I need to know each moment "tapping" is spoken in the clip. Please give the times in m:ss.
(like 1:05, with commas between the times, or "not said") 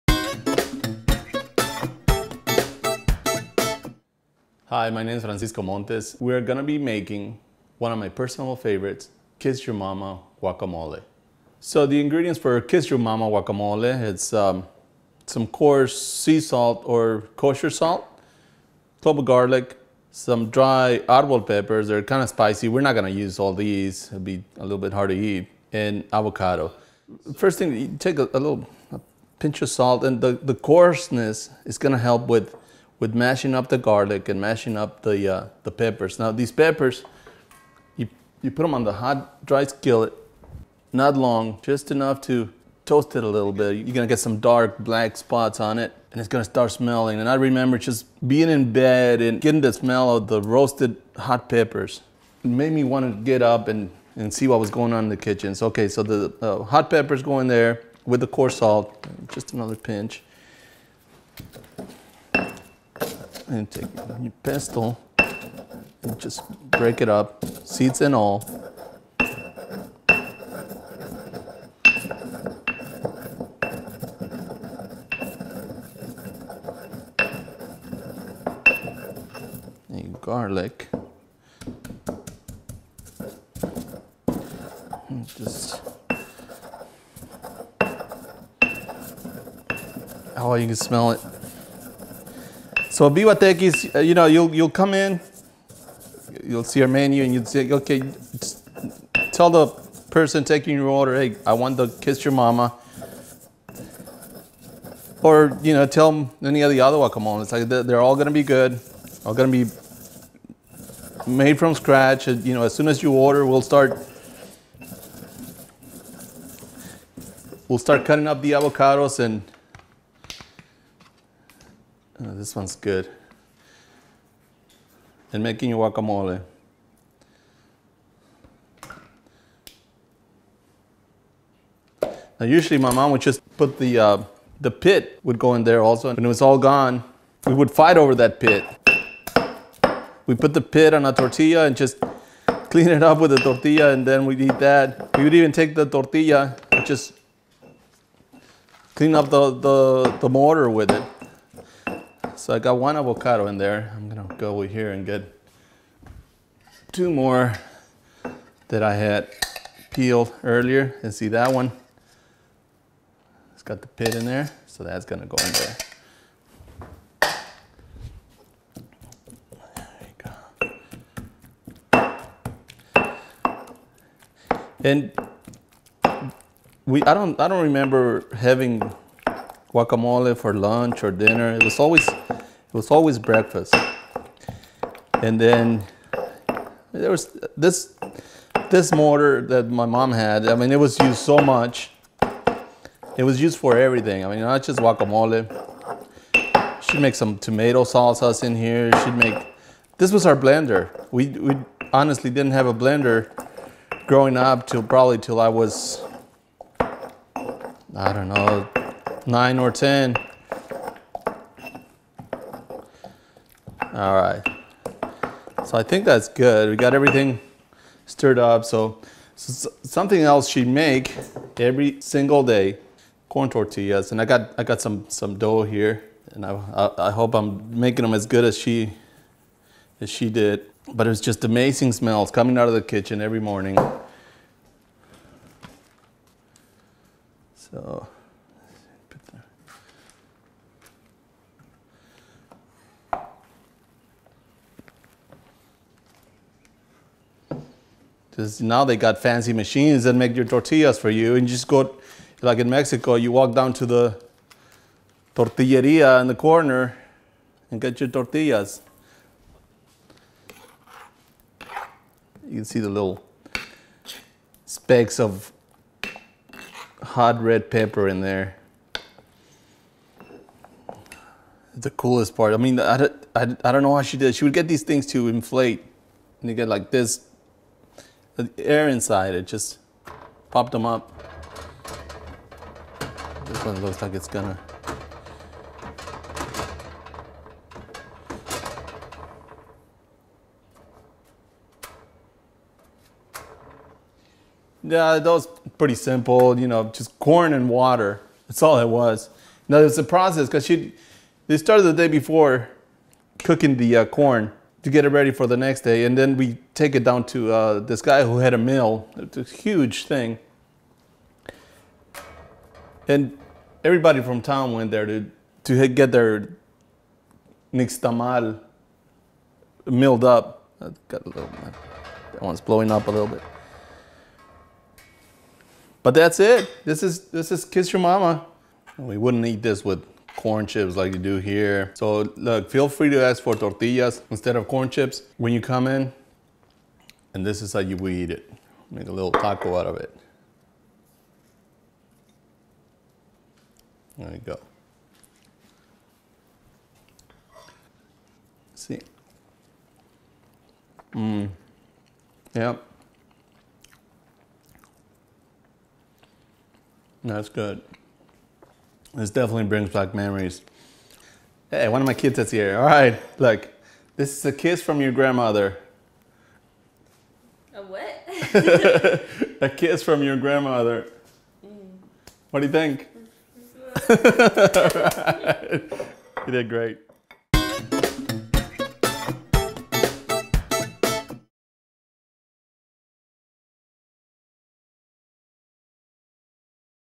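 not said.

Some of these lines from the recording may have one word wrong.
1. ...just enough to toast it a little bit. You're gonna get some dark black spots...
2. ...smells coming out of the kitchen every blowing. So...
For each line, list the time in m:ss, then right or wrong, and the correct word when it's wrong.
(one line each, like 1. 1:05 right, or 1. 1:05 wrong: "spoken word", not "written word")
1. 0:41 right
2. 3:51 wrong: "morning", not "blowing".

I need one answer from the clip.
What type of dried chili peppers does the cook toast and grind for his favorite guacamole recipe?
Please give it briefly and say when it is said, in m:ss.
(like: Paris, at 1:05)
arbol peppers, at 0:21.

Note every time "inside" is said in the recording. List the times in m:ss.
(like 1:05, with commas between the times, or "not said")
4:38.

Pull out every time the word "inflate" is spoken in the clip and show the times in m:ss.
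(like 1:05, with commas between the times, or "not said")
4:35.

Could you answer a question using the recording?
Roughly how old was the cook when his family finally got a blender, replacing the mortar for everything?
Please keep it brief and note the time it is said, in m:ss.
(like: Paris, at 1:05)
9 or 10, at 3:29.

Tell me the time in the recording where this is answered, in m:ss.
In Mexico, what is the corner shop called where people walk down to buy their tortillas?
4:15.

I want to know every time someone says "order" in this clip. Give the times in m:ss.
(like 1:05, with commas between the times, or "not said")
1:40, 1:53.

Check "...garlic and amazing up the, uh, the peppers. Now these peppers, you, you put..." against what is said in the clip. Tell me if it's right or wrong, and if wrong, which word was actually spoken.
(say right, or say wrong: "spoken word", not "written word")
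wrong: "mashing", not "amazing".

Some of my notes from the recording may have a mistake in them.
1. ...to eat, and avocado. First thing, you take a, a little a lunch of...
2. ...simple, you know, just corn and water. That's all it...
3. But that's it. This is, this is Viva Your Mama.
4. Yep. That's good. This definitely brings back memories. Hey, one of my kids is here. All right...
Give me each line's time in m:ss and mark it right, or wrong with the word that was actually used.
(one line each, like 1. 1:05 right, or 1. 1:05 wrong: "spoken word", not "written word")
1. 0:25 wrong: "pinch", not "lunch"
2. 4:55 right
3. 5:26 wrong: "Kiss", not "Viva"
4. 5:52 right.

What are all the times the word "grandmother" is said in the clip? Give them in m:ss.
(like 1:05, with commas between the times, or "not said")
6:05, 6:10.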